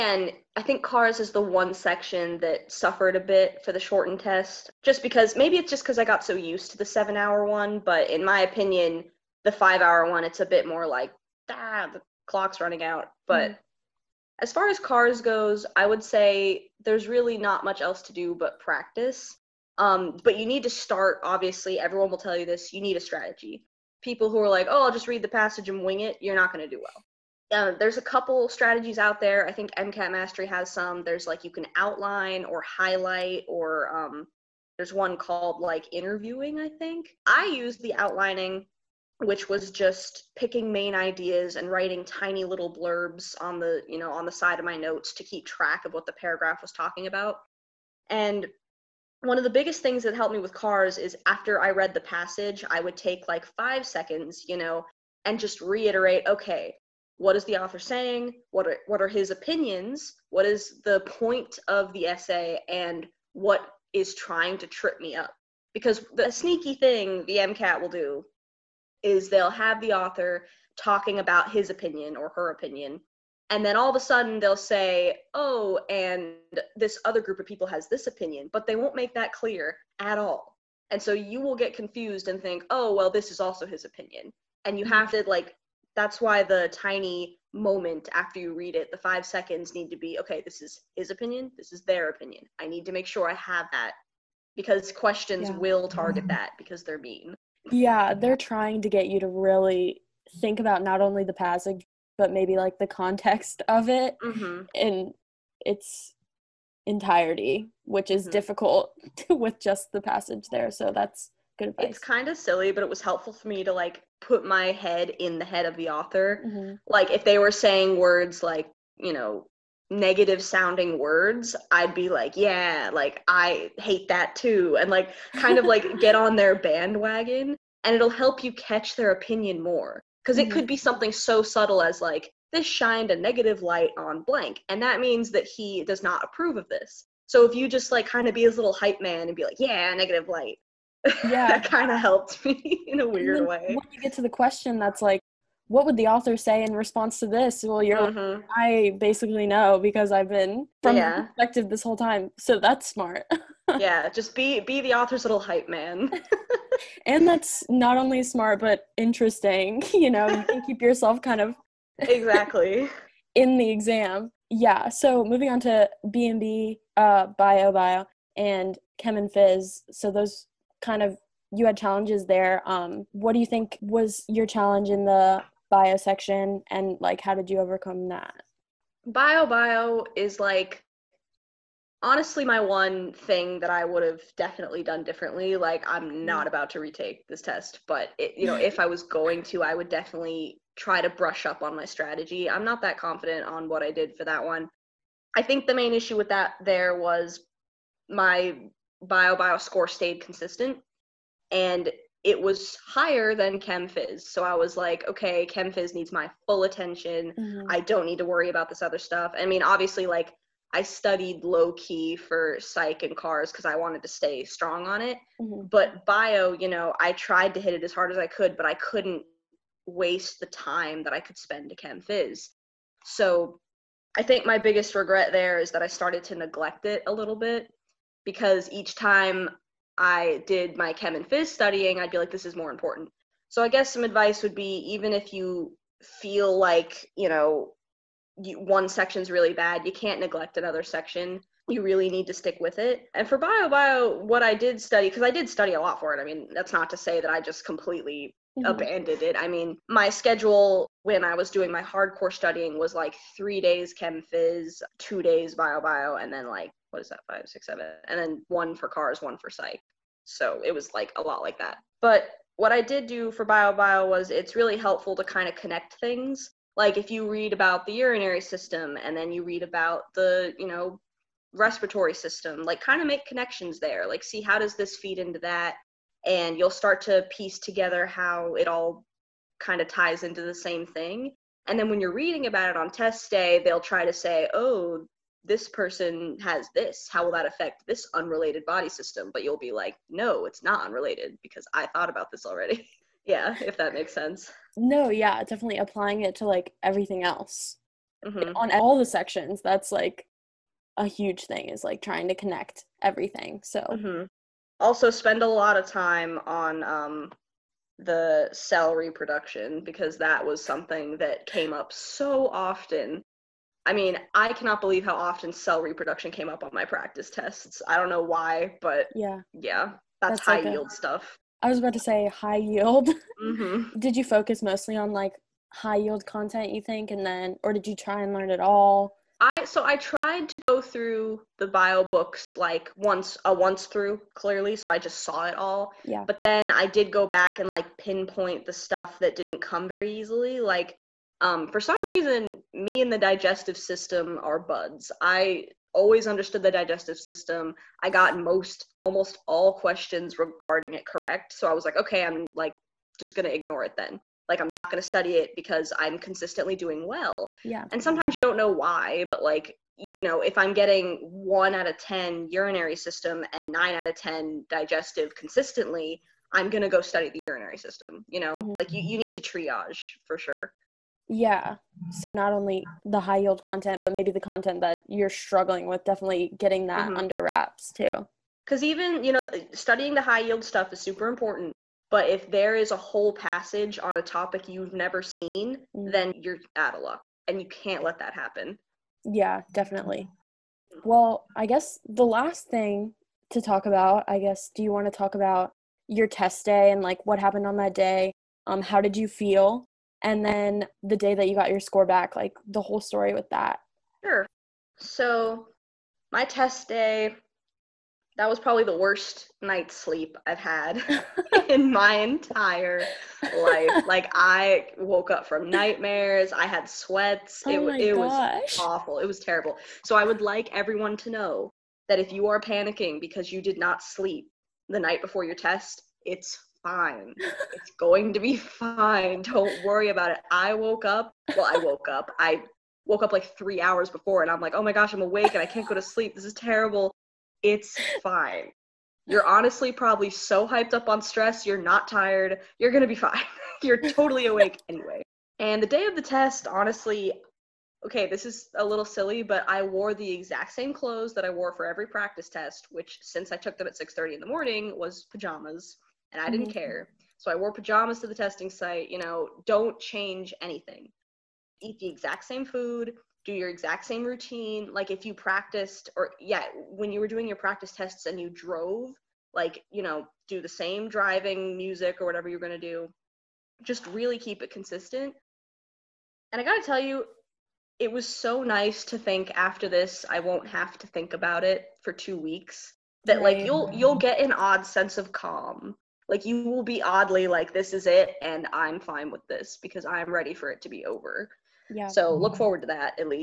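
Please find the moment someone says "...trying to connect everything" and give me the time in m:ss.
5:01.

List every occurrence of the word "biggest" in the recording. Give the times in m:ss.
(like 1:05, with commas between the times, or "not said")
0:49, 3:44.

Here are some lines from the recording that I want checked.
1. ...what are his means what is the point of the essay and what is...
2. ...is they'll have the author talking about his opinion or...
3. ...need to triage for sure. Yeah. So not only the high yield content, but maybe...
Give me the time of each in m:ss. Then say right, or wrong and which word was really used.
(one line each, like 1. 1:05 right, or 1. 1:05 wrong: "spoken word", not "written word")
1. 0:58 wrong: "opinions", not "means"
2. 1:09 right
3. 6:09 right.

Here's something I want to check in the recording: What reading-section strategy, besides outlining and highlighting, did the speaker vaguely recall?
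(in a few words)
interviewing.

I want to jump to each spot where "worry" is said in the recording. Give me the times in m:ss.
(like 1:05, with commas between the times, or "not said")
3:28, 7:09.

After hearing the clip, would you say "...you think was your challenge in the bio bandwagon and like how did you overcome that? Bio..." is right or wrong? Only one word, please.
wrong.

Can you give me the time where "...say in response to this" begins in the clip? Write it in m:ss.
2:26.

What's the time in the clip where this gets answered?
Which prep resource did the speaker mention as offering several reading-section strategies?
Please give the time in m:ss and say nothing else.
0:29.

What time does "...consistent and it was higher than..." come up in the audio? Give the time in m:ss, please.
3:20.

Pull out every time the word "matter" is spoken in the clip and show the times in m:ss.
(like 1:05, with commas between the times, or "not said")
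not said.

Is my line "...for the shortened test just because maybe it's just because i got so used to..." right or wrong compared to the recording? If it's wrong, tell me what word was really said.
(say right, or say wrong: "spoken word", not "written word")
right.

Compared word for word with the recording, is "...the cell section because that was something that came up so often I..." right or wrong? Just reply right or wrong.
wrong.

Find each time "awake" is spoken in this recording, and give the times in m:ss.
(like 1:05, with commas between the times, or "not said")
7:15, 7:24.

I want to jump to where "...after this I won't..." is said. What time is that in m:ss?
7:59.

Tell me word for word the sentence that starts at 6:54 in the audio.
Like, I woke up from nightmares, I had sweats.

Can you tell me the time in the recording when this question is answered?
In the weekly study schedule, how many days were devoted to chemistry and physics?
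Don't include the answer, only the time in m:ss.
4:13.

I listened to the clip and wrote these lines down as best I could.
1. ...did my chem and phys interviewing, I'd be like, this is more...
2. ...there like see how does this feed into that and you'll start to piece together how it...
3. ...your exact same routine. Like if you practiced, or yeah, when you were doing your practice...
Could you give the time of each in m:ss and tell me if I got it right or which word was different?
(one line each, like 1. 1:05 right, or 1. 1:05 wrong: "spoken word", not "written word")
1. 3:50 wrong: "studying", not "interviewing"
2. 4:33 right
3. 7:43 right.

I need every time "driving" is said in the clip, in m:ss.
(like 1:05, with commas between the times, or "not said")
7:51.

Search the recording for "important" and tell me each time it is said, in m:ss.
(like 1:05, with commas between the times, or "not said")
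3:52, 6:21.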